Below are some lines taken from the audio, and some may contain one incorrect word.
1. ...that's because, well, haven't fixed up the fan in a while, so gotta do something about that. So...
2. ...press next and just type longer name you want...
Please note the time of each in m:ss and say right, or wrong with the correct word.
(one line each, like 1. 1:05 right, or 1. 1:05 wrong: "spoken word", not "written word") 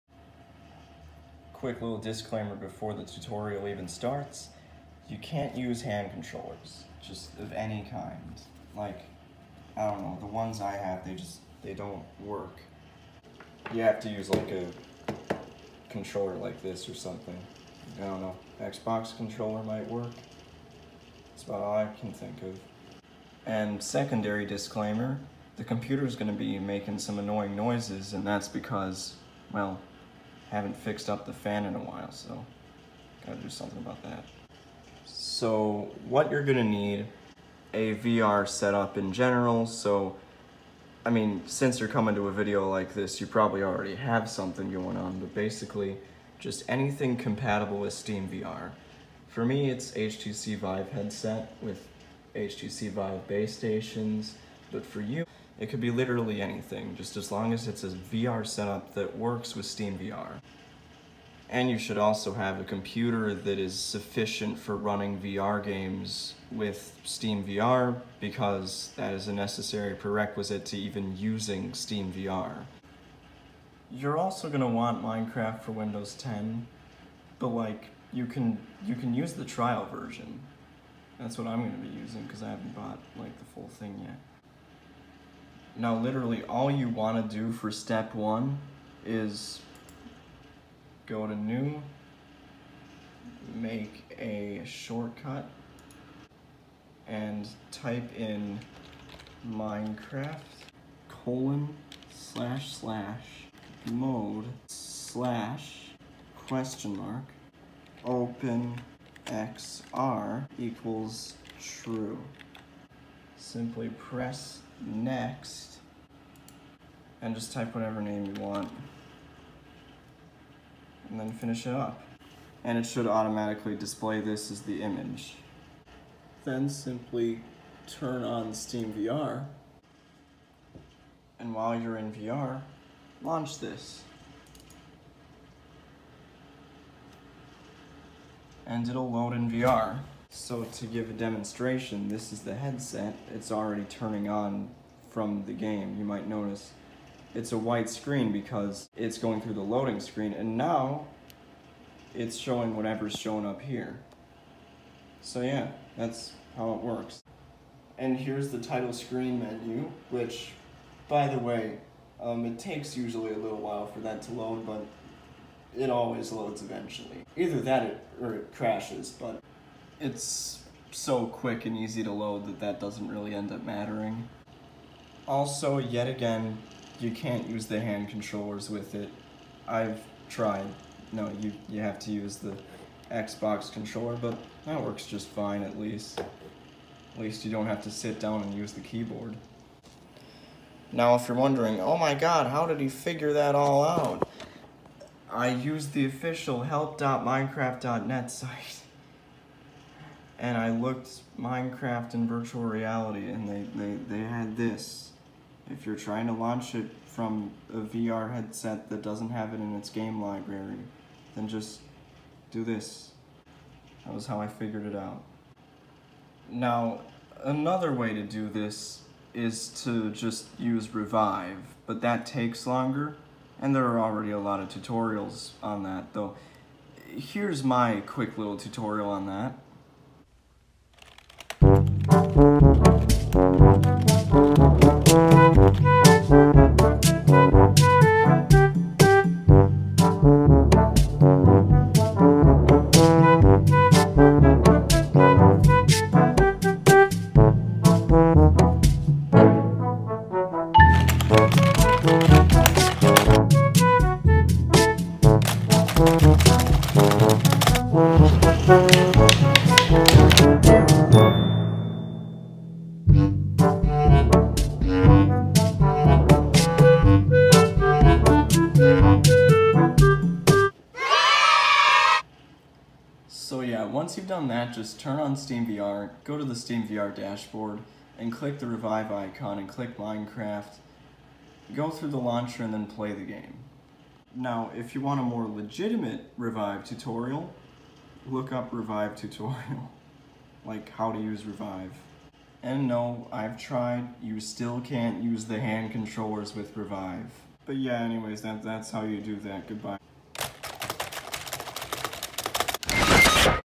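1. 0:28 right
2. 1:53 wrong: "whatever", not "longer".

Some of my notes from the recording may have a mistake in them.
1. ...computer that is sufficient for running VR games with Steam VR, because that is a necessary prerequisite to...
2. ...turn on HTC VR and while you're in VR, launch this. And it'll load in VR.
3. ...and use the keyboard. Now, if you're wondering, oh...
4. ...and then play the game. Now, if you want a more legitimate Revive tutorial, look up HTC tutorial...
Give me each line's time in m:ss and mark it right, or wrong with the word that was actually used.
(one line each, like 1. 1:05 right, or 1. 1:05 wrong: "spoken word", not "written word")
1. 1:02 right
2. 2:07 wrong: "Steam", not "HTC"
3. 3:08 right
4. 4:42 wrong: "Revive", not "HTC".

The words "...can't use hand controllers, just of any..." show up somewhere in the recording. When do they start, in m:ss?
0:05.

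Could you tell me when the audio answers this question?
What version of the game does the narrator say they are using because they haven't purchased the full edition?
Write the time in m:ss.
1:19.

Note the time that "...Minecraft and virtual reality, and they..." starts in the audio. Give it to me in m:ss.
3:21.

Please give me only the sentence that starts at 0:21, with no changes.
That's about all I can think of.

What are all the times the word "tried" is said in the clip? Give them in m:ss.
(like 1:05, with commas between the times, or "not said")
3:00, 4:53.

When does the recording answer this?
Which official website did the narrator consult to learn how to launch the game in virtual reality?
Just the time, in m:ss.
3:16.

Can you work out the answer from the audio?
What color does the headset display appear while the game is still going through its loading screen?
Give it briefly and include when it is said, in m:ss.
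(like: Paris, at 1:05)
white, at 2:27.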